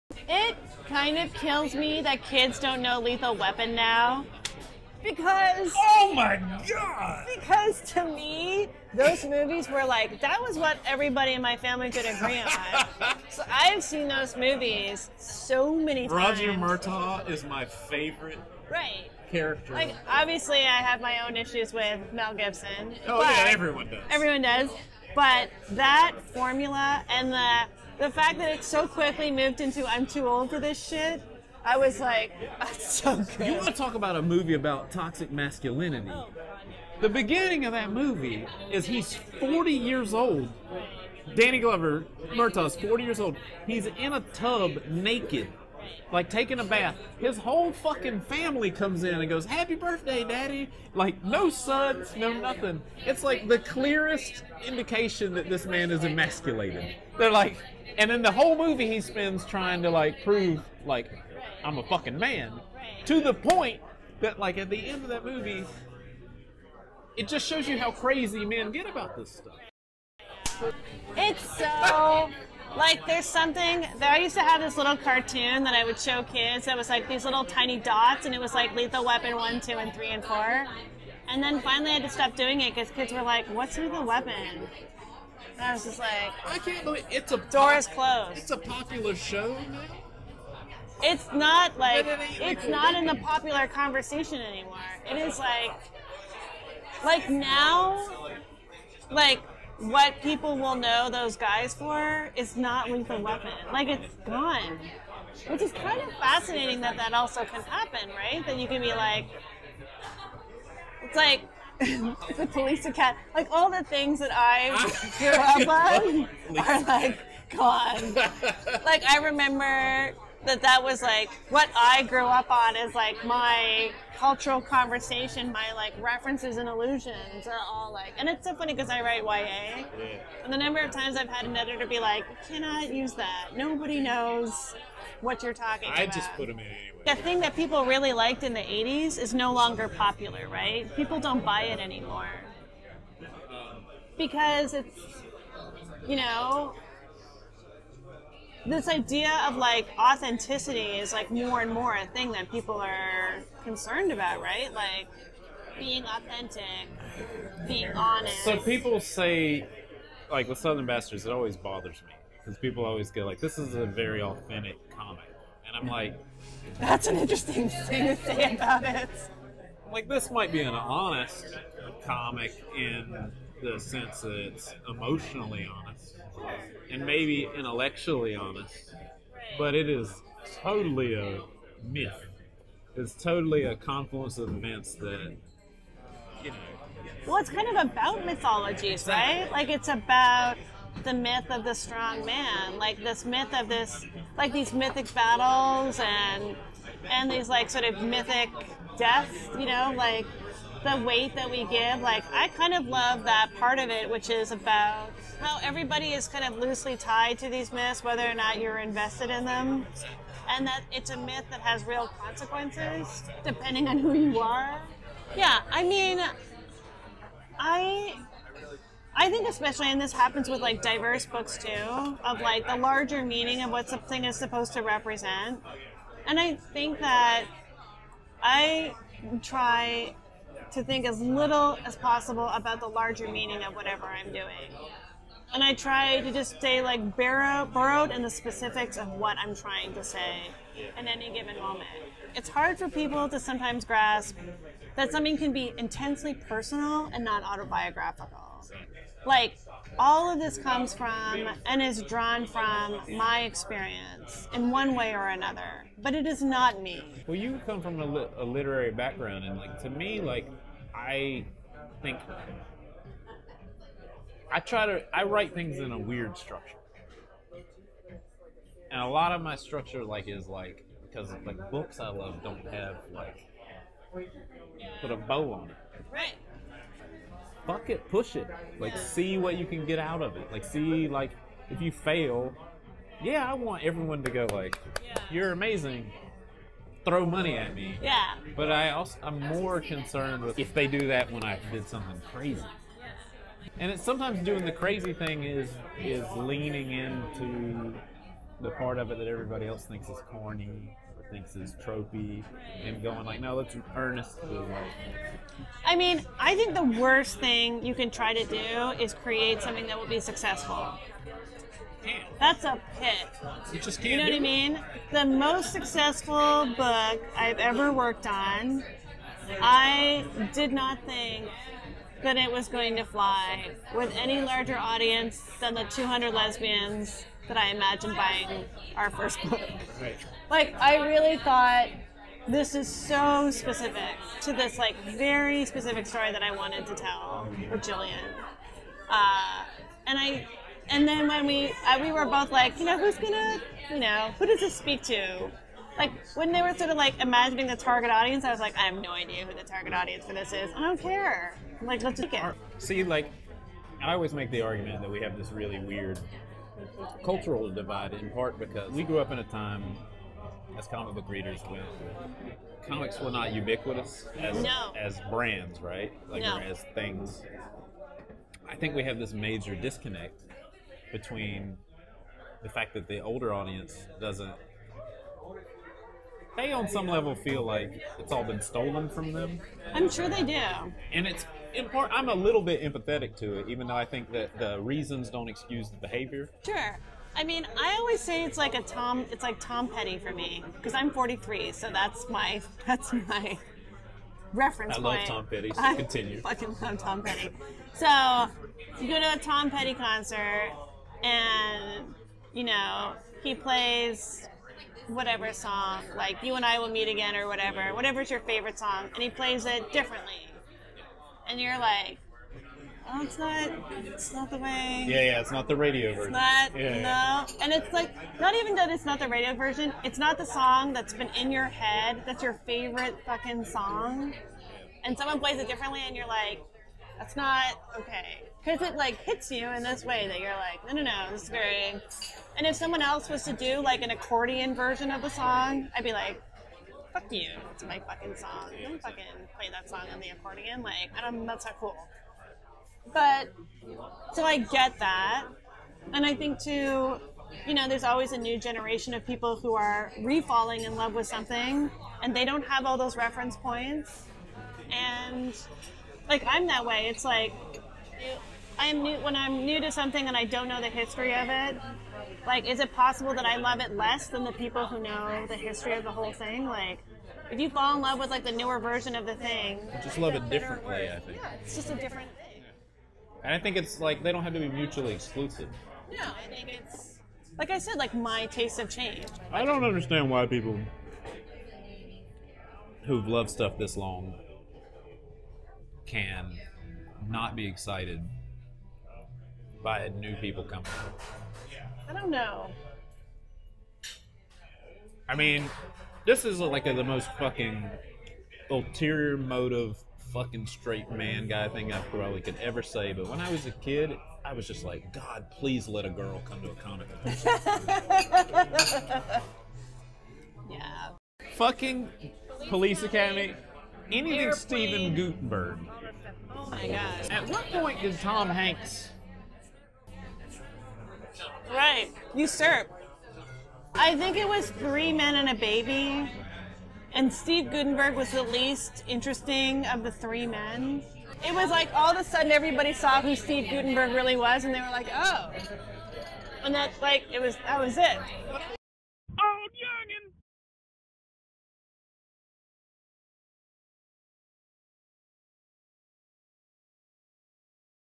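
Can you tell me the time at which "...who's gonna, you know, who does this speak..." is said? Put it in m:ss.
5:42.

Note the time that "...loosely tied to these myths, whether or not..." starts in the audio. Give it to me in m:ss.
3:26.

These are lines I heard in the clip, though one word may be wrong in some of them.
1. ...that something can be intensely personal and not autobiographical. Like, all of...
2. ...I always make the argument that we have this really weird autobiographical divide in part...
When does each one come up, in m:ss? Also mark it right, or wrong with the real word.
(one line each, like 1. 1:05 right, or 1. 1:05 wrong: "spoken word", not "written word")
1. 4:04 right
2. 5:54 wrong: "cultural", not "autobiographical".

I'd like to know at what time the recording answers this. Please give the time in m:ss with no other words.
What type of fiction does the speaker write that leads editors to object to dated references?
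2:09.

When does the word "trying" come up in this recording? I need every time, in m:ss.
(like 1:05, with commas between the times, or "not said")
0:59, 3:59.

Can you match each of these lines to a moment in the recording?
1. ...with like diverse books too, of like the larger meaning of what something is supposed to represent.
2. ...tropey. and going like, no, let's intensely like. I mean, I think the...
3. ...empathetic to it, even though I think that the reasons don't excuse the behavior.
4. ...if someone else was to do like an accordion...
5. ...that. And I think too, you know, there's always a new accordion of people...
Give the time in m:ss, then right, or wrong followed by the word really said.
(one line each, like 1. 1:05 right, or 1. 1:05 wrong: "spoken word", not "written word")
1. 3:40 right
2. 5:01 wrong: "earnestly", not "intensely"
3. 6:22 right
4. 7:12 right
5. 7:24 wrong: "generation", not "accordion".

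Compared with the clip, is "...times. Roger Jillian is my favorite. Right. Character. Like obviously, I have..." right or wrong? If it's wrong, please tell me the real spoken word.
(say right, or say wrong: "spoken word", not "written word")
wrong: "Murtaugh", not "Jillian".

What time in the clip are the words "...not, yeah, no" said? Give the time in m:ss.
6:56.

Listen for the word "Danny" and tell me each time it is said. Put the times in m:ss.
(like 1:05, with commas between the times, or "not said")
0:41.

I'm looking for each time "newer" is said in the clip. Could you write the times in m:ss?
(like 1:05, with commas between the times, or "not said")
7:48.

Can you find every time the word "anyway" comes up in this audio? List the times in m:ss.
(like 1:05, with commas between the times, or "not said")
2:16.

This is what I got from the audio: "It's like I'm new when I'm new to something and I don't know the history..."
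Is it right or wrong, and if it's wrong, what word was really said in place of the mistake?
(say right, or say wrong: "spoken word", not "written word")
right.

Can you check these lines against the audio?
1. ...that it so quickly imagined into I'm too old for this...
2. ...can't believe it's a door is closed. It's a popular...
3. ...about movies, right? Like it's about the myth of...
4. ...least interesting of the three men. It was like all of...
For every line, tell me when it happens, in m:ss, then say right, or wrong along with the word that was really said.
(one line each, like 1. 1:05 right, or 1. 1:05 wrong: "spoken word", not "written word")
1. 0:28 wrong: "moved", not "imagined"
2. 1:26 right
3. 3:07 wrong: "mythologies", not "movies"
4. 8:48 right.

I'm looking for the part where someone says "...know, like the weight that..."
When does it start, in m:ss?
3:19.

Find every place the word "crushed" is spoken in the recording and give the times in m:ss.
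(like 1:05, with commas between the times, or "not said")
not said.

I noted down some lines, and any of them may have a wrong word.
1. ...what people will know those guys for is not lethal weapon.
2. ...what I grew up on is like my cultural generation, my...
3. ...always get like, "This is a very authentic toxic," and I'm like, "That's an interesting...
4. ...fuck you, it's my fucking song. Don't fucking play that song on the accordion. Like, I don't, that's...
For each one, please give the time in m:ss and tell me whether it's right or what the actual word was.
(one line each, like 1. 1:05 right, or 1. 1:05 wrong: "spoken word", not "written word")
1. 1:39 right
2. 2:01 wrong: "conversation", not "generation"
3. 2:42 wrong: "comic", not "toxic"
4. 7:17 right.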